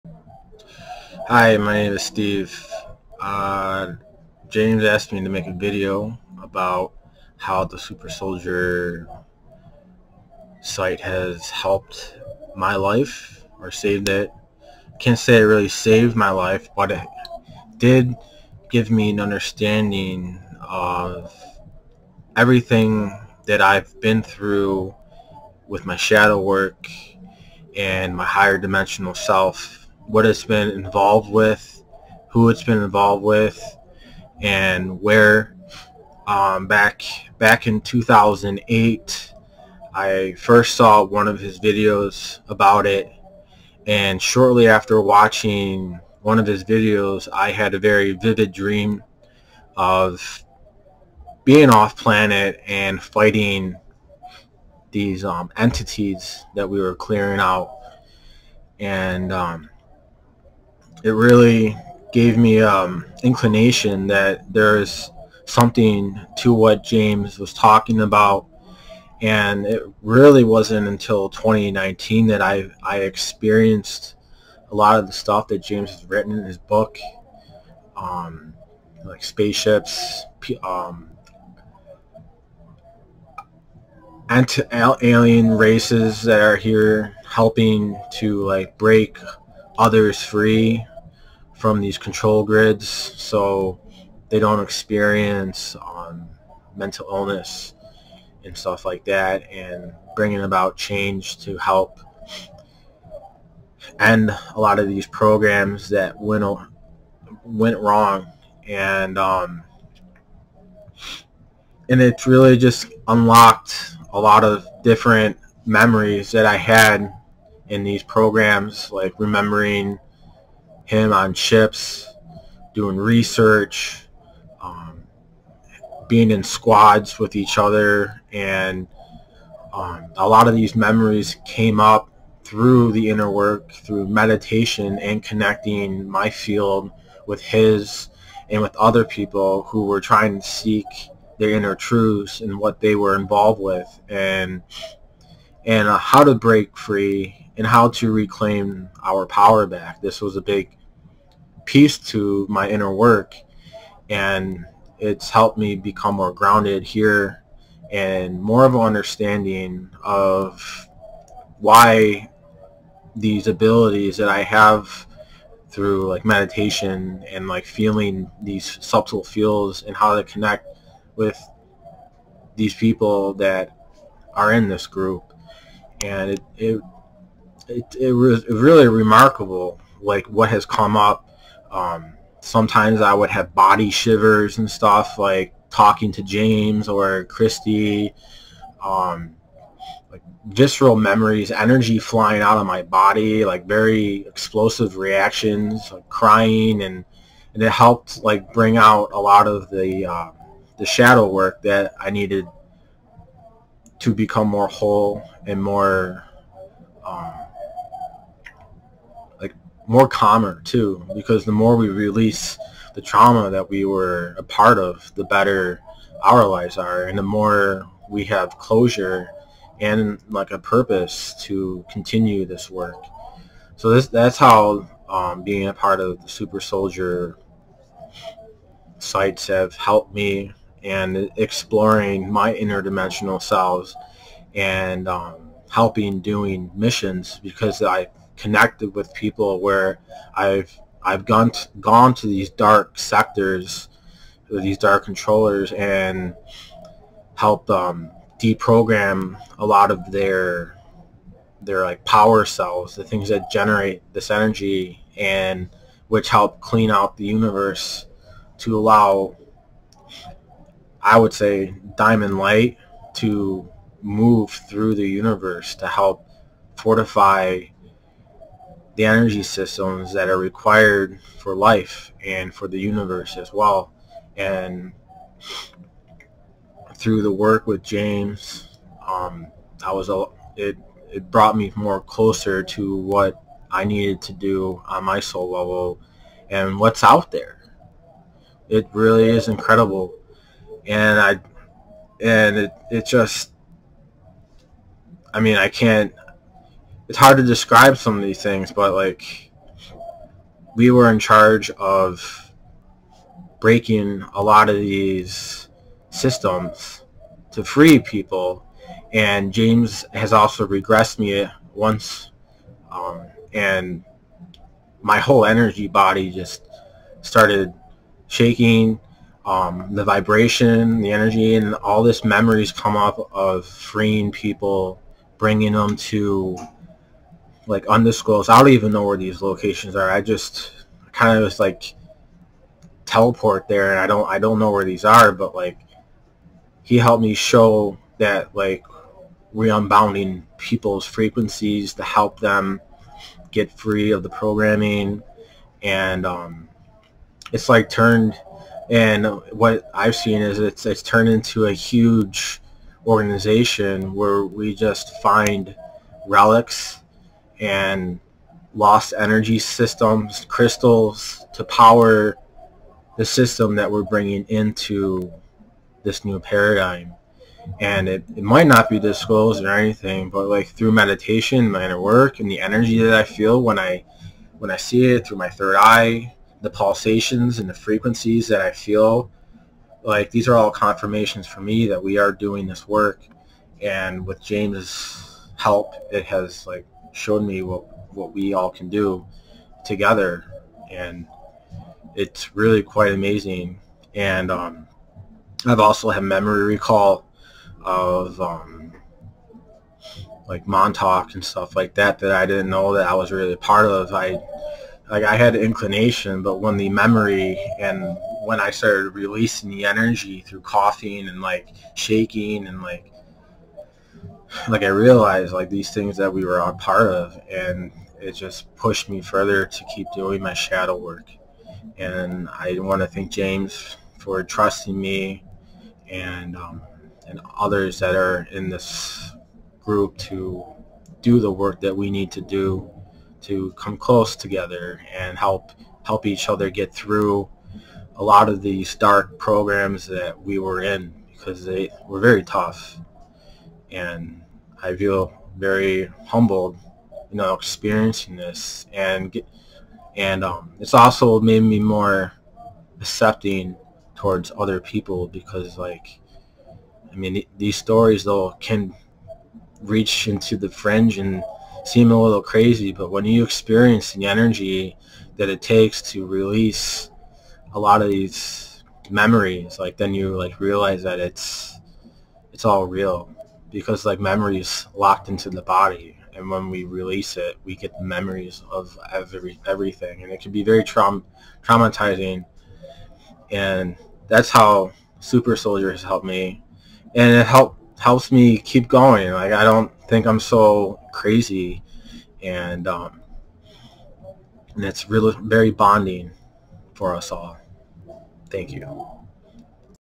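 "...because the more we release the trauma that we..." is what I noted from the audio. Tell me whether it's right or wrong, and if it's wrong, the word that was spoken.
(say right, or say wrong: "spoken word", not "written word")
right.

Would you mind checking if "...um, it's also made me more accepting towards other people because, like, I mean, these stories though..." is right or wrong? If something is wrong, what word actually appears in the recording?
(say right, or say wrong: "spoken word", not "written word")
right.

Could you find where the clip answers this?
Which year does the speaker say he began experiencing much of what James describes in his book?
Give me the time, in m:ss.
1:11.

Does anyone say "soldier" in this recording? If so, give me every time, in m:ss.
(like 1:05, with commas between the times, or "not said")
0:08, 3:46, 8:05.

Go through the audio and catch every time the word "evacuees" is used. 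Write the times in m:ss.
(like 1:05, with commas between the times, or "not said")
not said.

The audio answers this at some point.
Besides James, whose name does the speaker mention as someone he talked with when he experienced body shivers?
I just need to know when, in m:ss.
3:07.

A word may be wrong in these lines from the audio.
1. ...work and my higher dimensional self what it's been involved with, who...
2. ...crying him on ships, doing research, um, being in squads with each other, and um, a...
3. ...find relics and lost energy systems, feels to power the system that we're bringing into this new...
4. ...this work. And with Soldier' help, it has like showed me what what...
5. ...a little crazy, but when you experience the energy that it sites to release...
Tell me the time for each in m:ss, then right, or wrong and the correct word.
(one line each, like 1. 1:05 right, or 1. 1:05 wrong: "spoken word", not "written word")
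1. 0:26 right
2. 1:59 wrong: "remembering", not "crying"
3. 5:55 wrong: "crystals", not "feels"
4. 6:22 wrong: "James", not "Soldier"
5. 7:42 wrong: "takes", not "sites".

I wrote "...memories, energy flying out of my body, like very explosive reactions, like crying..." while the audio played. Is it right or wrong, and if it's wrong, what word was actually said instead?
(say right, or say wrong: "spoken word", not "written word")
right.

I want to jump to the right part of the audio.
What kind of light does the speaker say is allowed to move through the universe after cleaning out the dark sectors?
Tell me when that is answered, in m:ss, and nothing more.
4:21.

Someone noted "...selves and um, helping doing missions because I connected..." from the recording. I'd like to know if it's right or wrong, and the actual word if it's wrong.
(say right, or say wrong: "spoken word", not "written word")
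right.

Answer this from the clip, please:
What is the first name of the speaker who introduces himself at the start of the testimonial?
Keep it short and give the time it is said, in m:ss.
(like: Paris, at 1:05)
Steve, at 0:02.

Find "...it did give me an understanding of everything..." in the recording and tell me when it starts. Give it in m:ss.
0:16.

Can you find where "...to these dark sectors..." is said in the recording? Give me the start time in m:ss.
4:02.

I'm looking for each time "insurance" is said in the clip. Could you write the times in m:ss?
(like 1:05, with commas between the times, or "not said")
not said.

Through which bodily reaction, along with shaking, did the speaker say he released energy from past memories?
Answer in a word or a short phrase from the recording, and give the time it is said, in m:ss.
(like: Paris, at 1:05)
coughing, at 6:50.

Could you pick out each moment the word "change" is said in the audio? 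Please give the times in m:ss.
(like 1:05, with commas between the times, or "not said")
1:40.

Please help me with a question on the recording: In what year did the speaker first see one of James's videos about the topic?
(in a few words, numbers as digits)
2008.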